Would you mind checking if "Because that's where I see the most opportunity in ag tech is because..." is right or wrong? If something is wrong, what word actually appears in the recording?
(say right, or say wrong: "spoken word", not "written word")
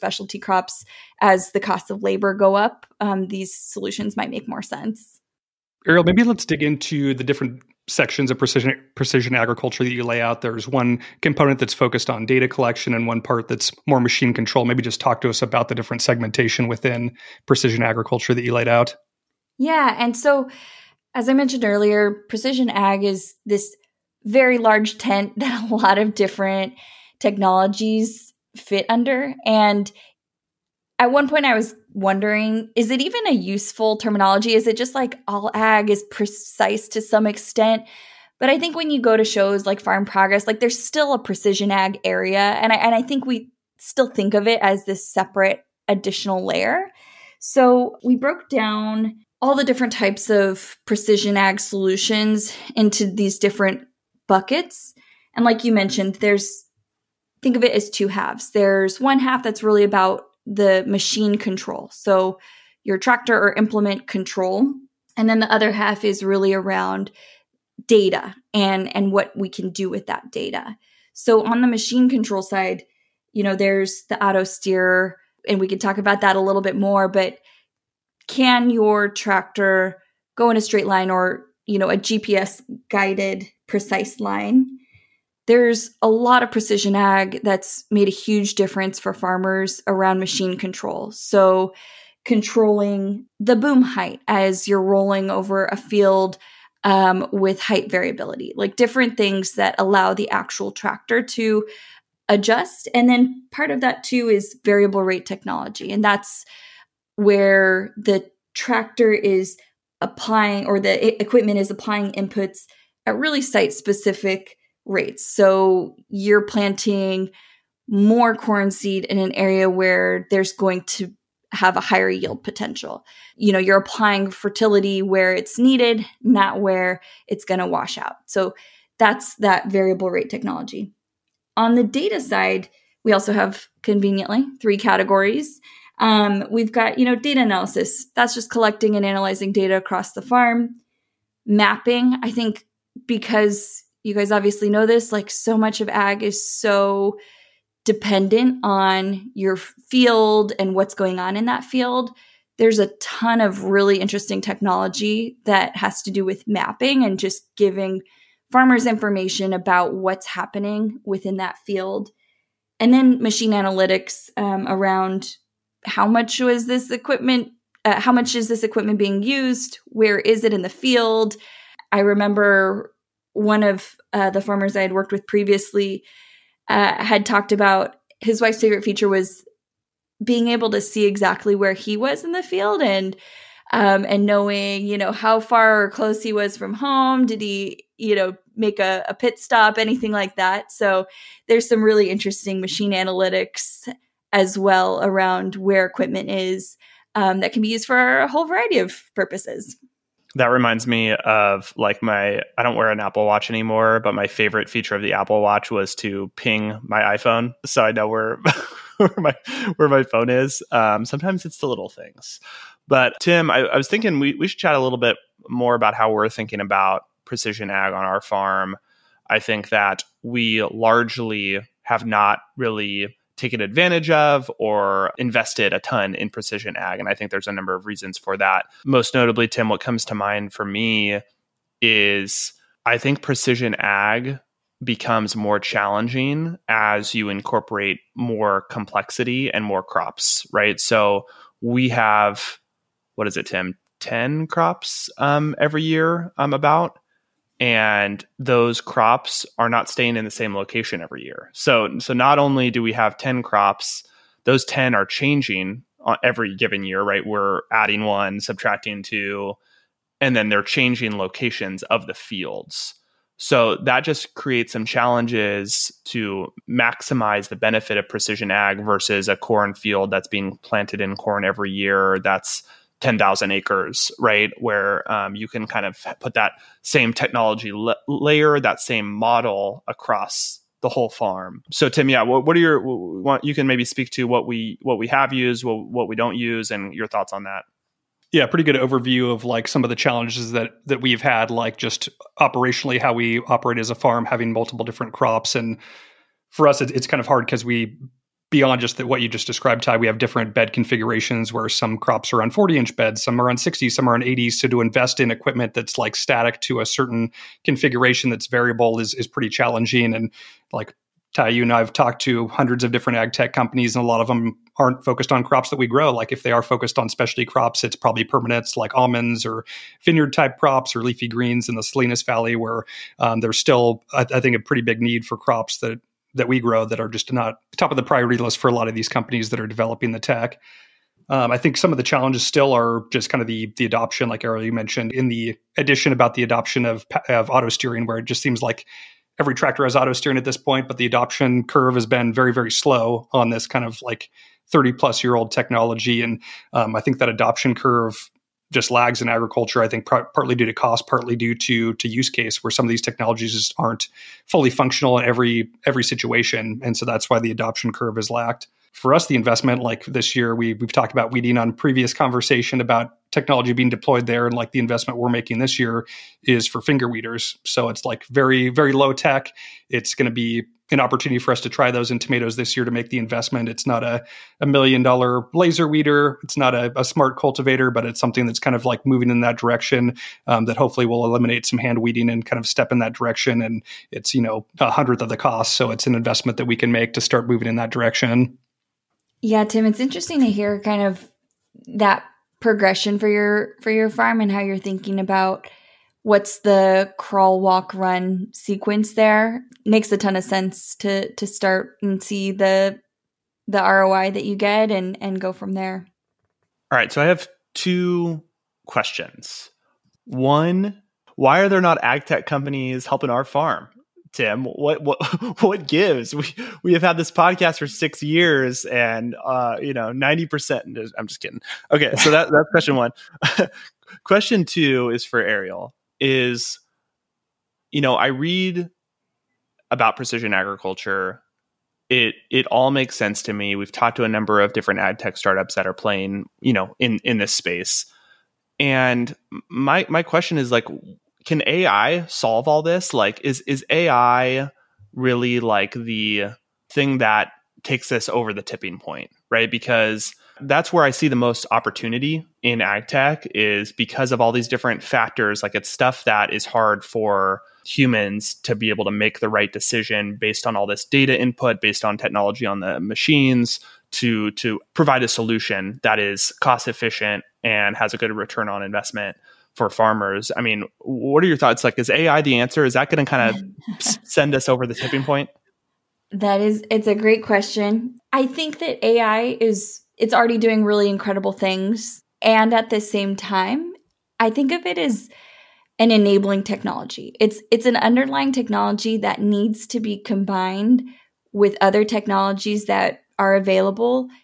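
right.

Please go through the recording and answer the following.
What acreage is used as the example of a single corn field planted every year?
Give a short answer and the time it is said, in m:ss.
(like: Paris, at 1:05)
10,000 acres, at 4:33.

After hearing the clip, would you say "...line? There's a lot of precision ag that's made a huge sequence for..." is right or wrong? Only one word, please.
wrong.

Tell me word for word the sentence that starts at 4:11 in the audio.
So so not only do we have 10 crops, those 10 are changing on every given year, right?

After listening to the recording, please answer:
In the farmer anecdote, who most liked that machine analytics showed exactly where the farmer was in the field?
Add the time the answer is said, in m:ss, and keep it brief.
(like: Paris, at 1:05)
His wife, at 2:58.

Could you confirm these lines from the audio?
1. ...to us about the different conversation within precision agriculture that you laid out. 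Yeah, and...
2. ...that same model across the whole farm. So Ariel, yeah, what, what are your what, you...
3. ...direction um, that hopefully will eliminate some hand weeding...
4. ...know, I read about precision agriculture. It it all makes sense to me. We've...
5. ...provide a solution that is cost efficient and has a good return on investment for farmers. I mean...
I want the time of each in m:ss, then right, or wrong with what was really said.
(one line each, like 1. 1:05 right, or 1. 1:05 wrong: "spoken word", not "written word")
1. 0:15 wrong: "segmentation", not "conversation"
2. 4:38 wrong: "Tim", not "Ariel"
3. 6:19 right
4. 7:07 right
5. 7:44 right.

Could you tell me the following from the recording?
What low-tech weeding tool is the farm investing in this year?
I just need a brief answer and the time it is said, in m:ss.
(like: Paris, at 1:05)
Finger weeders, at 6:06.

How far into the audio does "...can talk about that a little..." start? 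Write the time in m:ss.
1:15.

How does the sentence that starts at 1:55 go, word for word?
So you're planting more corn seed in an area where there's going to have a higher yield potential.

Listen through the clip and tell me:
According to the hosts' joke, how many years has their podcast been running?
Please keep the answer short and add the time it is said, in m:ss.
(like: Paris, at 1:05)
6, at 6:57.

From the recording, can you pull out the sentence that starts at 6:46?
All right, so I have two questions.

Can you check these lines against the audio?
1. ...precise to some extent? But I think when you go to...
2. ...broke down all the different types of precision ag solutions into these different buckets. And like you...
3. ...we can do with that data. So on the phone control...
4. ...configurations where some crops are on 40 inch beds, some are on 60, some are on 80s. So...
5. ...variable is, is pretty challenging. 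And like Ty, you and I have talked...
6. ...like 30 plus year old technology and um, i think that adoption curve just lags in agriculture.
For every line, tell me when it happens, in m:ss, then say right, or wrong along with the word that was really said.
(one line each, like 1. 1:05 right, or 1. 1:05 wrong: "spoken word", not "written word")
1. 0:36 right
2. 0:48 right
3. 1:09 wrong: "machine", not "phone"
4. 5:00 right
5. 5:08 right
6. 5:44 right.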